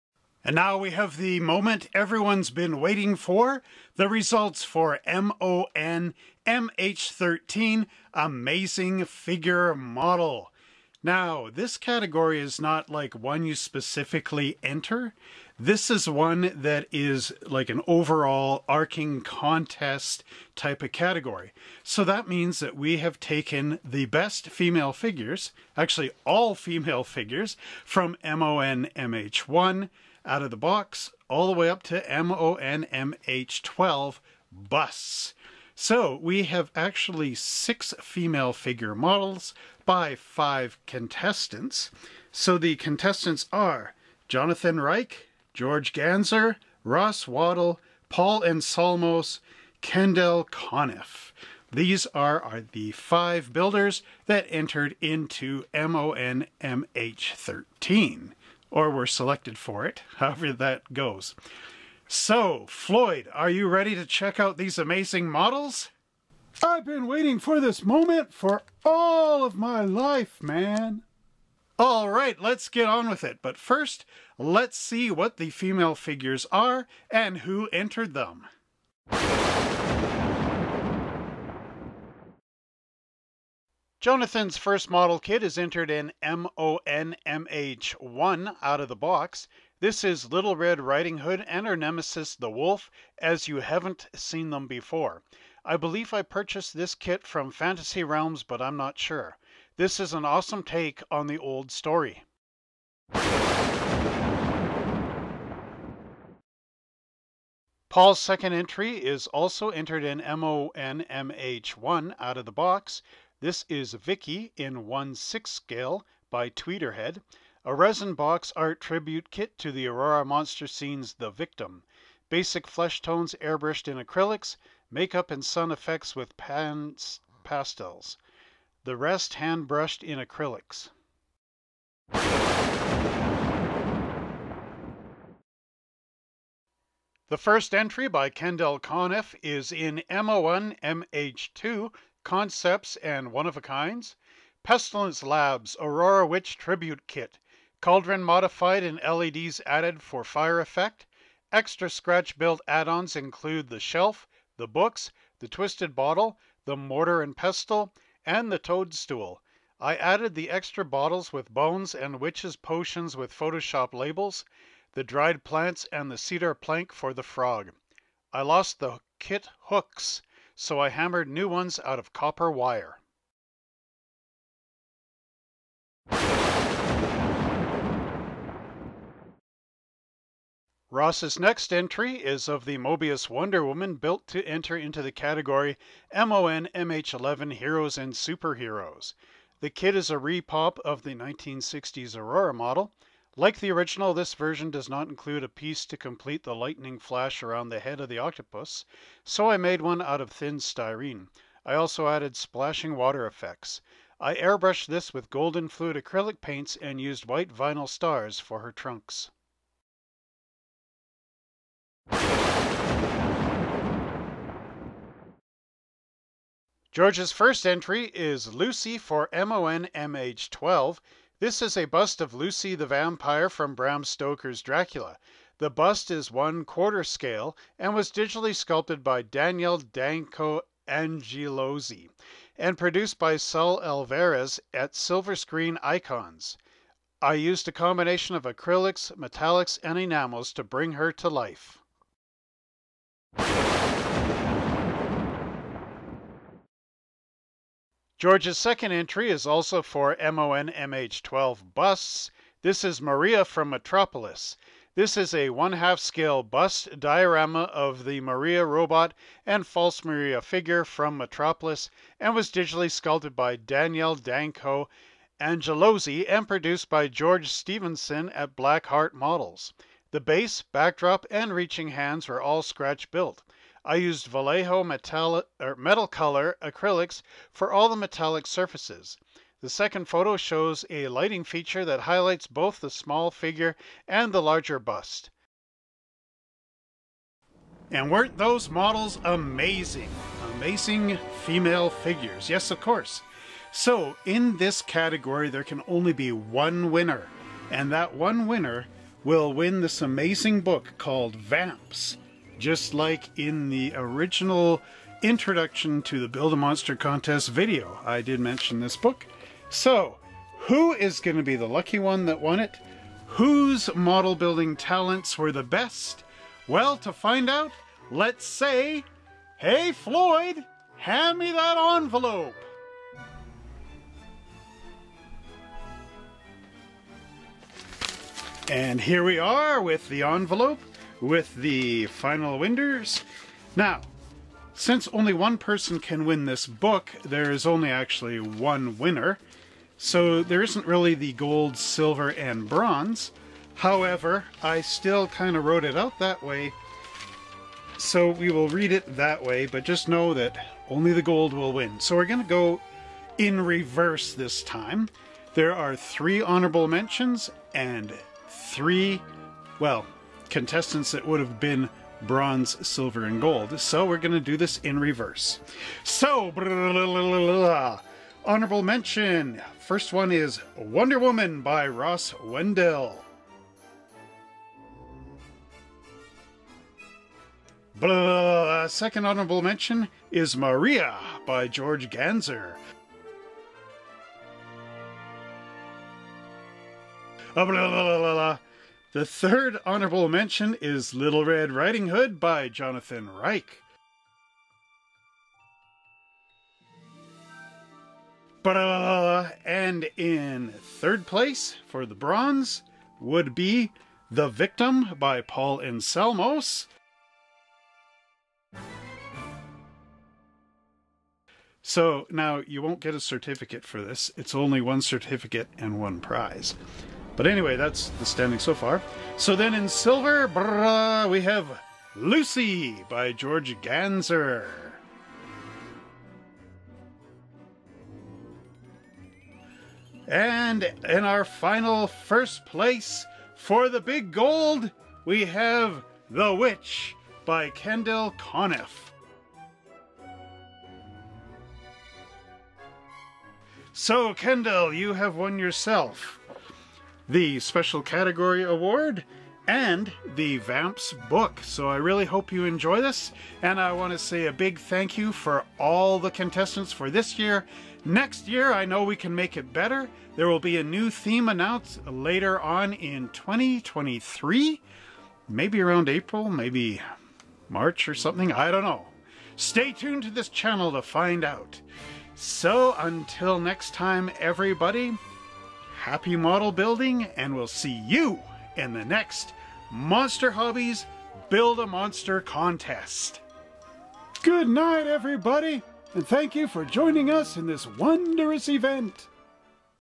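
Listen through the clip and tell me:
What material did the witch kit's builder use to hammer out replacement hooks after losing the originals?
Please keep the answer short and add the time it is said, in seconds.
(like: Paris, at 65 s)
Copper wire, at 172 s.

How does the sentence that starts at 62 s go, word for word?
So, Floyd, are you ready to check out these amazing models?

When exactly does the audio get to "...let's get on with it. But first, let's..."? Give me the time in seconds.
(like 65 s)
72 s.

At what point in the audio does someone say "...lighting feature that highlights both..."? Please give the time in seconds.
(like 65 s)
281 s.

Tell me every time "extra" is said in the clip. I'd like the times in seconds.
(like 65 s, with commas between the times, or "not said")
151 s, 160 s.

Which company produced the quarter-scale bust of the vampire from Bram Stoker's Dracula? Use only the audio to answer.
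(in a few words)
Silver Screen Icons.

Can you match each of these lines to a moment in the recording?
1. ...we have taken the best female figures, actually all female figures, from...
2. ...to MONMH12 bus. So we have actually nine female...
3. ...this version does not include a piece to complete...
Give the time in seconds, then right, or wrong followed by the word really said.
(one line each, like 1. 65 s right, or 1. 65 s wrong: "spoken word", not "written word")
1. 22 s right
2. 31 s wrong: "six", not "nine"
3. 194 s right.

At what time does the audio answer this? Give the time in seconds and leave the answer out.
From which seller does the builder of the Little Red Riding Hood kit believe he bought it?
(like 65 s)
97 s.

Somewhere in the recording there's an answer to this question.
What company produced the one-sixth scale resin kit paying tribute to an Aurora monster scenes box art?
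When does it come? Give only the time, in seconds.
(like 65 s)
116 s.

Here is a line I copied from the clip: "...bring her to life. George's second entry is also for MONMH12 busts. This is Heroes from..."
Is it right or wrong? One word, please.
wrong.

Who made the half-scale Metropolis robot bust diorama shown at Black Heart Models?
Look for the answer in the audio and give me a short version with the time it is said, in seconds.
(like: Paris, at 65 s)
George Stevenson, at 267 s.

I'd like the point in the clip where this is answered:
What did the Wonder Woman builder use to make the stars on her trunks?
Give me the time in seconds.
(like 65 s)
207 s.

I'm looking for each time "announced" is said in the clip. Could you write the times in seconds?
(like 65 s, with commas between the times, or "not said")
461 s.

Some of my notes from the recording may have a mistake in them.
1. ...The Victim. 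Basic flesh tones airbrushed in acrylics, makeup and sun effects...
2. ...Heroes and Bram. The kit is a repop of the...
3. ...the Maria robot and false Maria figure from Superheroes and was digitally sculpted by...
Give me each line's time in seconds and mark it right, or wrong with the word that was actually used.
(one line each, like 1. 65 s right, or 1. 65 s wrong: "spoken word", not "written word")
1. 121 s right
2. 187 s wrong: "Superheroes", not "Bram"
3. 258 s wrong: "Metropolis", not "Superheroes".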